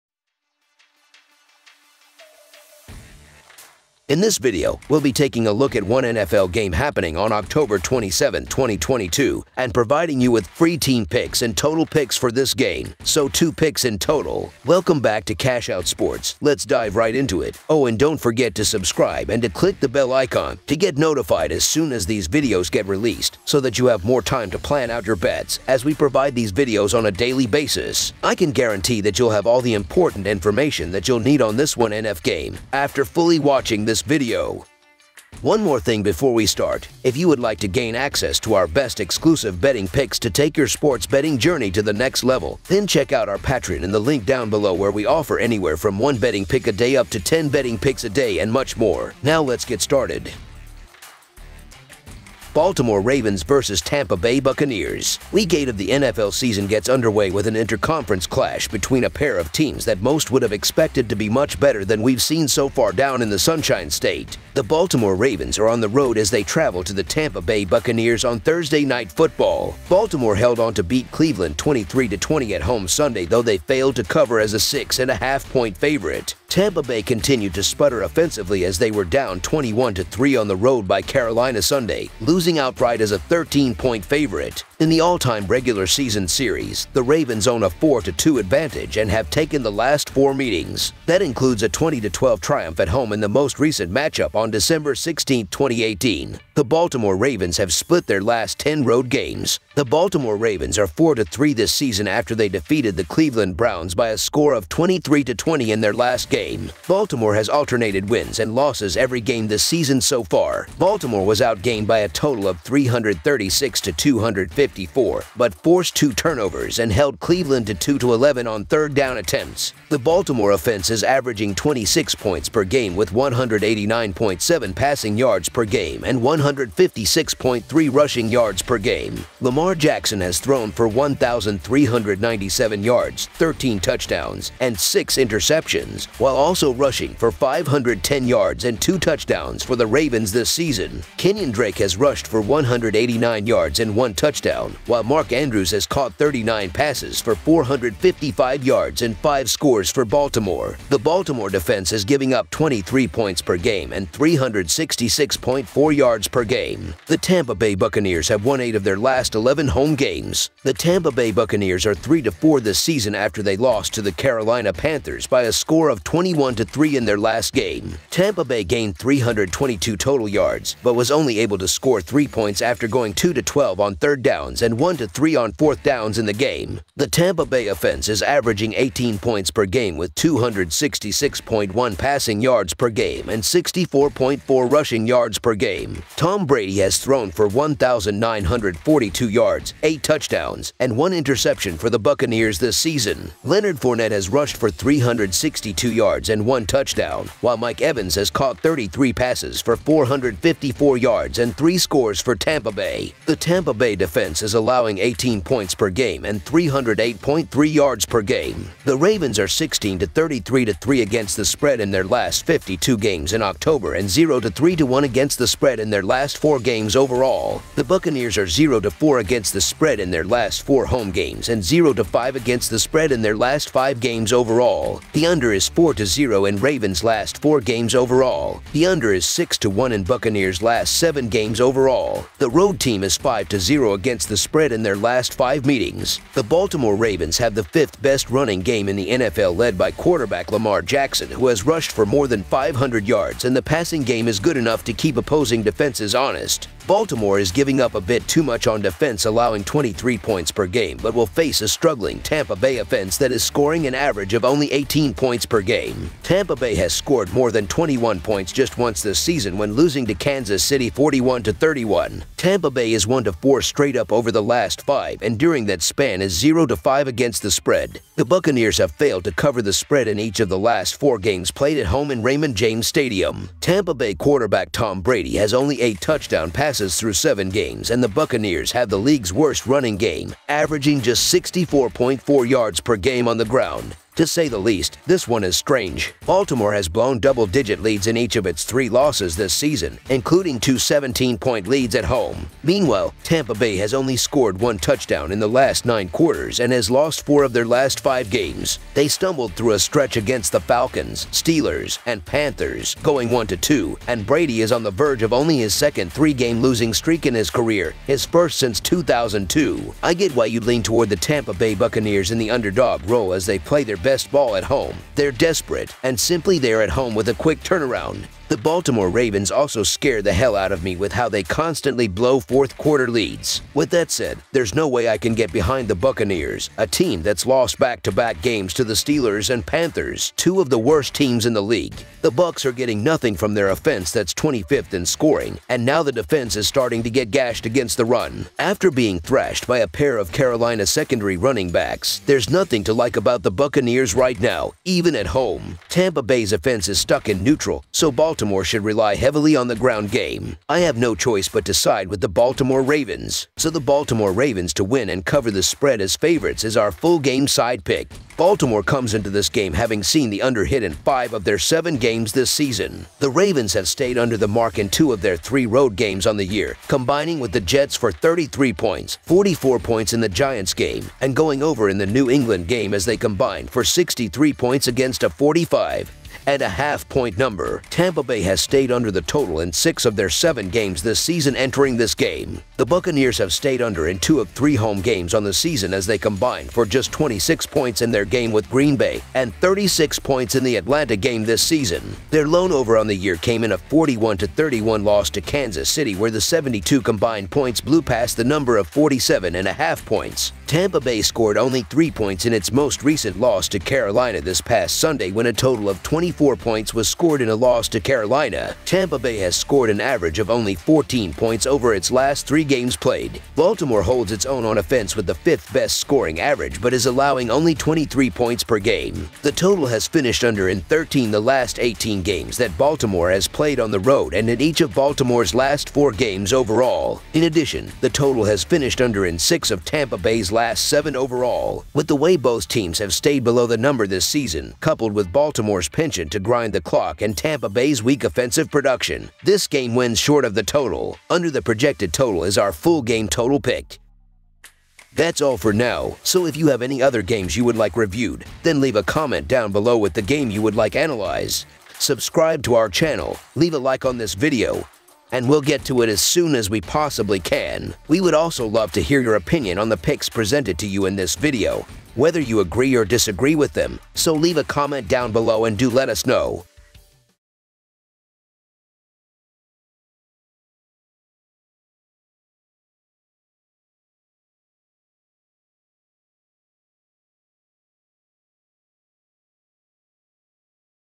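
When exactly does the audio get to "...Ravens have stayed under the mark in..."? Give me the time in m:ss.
6:03.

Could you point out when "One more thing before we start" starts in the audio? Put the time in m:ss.
0:35.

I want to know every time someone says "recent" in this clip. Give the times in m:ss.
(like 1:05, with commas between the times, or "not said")
1:33, 6:43.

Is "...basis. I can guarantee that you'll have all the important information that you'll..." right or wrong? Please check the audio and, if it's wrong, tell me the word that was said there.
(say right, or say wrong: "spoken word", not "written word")
right.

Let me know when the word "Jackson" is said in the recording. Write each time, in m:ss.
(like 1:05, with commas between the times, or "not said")
2:09, 4:00.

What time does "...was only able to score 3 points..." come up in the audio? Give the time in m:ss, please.
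2:50.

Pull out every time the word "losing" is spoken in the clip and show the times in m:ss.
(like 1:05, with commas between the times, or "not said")
1:22, 4:19, 5:06.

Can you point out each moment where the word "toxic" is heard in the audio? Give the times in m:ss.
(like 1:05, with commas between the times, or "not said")
not said.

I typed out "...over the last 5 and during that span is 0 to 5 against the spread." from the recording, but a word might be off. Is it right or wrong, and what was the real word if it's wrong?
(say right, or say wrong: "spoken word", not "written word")
right.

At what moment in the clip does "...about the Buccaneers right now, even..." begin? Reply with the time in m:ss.
5:43.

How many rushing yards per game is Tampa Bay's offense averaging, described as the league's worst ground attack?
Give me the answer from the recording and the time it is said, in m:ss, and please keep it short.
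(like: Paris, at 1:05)
64.4, at 3:03.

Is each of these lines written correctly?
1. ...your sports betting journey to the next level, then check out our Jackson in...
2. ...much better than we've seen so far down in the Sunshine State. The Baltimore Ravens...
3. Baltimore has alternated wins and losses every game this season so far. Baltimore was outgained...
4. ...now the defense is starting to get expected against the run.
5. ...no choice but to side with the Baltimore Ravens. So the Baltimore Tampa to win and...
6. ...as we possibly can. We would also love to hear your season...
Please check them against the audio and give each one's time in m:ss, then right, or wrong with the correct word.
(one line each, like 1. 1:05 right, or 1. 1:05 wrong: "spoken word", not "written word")
1. 0:40 wrong: "Patreon", not "Jackson"
2. 1:01 right
3. 1:46 right
4. 5:35 wrong: "gashed", not "expected"
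5. 5:50 wrong: "Ravens", not "Tampa"
6. 7:36 wrong: "opinion", not "season".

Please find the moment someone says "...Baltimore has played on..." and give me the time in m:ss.
7:02.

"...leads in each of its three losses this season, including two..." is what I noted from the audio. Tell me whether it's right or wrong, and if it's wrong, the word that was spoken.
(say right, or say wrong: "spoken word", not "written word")
right.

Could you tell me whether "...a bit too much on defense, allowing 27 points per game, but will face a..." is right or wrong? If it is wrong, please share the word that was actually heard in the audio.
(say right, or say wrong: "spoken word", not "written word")
wrong: "23", not "27".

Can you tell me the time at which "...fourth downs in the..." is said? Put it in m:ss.
2:55.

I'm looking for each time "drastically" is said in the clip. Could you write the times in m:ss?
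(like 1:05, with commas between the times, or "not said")
not said.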